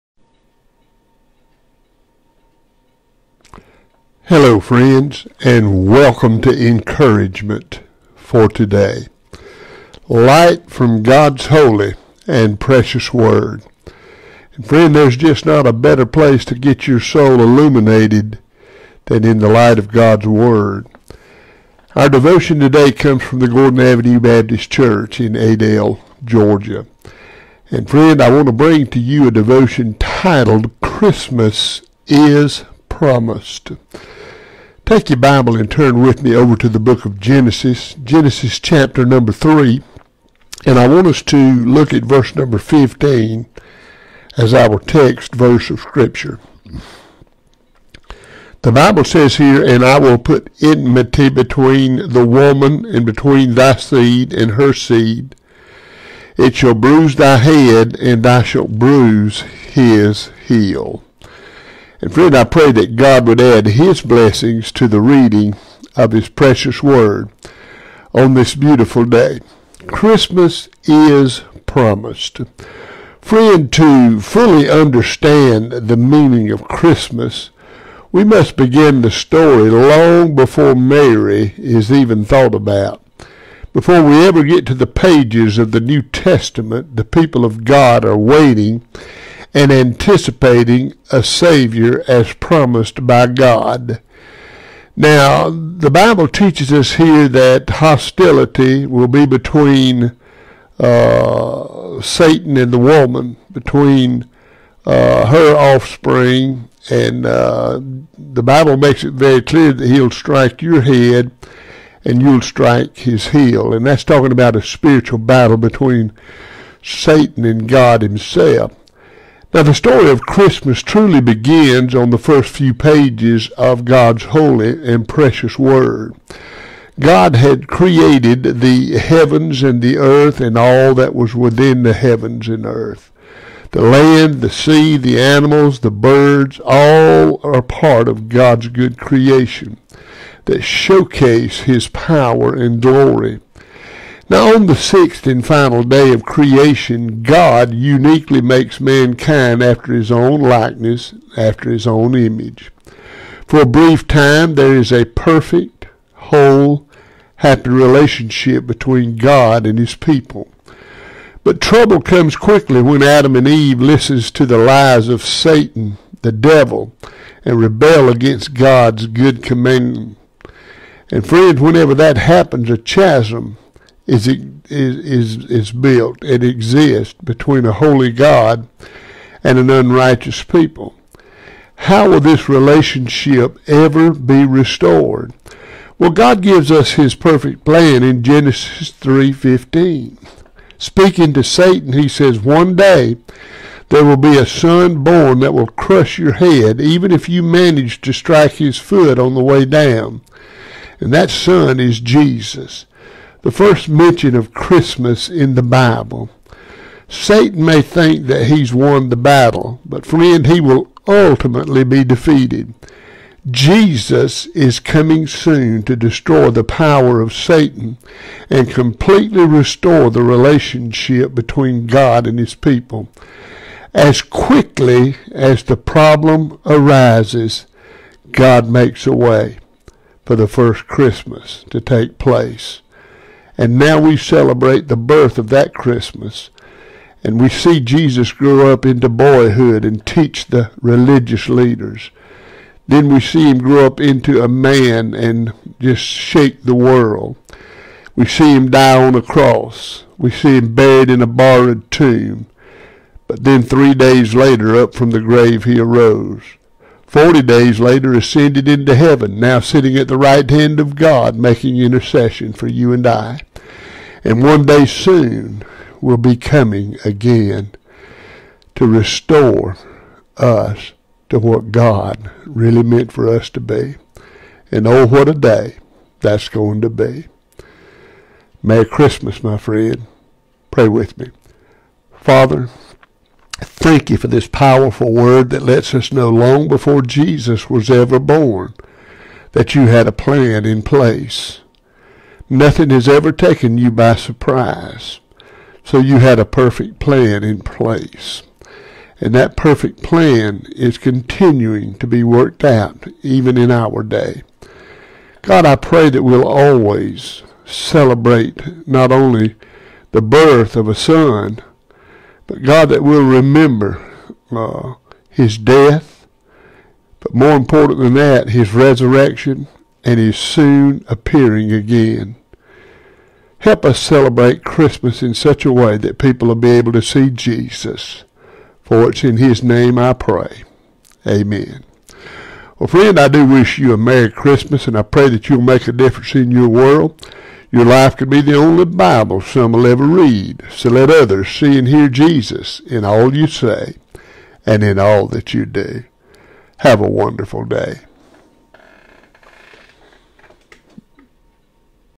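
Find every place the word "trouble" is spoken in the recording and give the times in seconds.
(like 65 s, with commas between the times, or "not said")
161 s.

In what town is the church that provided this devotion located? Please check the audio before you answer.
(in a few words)
Adel, Georgia.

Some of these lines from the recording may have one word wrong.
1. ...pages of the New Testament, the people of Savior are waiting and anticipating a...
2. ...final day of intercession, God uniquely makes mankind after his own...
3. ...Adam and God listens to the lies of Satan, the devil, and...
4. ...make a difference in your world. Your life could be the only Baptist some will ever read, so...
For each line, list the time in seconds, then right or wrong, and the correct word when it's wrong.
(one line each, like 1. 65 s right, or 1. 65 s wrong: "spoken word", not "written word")
1. 84 s wrong: "God", not "Savior"
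2. 145 s wrong: "creation", not "intercession"
3. 163 s wrong: "Eve", not "God"
4. 335 s wrong: "Bible", not "Baptist".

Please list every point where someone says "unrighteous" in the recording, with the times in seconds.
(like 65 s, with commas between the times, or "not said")
179 s.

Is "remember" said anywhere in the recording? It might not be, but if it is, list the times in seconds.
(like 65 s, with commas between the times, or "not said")
313 s.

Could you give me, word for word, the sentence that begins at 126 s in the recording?
God had created the heavens and the earth and all that was within the heavens and earth.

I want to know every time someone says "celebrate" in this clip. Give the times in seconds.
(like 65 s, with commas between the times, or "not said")
234 s, 307 s, 323 s.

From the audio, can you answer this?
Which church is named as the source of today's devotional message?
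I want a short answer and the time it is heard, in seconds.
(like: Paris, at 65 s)
Gordon Avenue Baptist Church, at 23 s.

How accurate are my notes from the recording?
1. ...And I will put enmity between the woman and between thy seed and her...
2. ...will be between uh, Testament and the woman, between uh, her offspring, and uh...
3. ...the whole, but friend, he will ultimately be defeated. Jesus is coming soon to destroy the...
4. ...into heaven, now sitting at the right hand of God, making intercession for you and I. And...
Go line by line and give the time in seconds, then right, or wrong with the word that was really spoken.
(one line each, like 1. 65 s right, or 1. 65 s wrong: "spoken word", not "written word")
1. 49 s right
2. 98 s wrong: "Satan", not "Testament"
3. 209 s wrong: "battle", not "whole"
4. 258 s right.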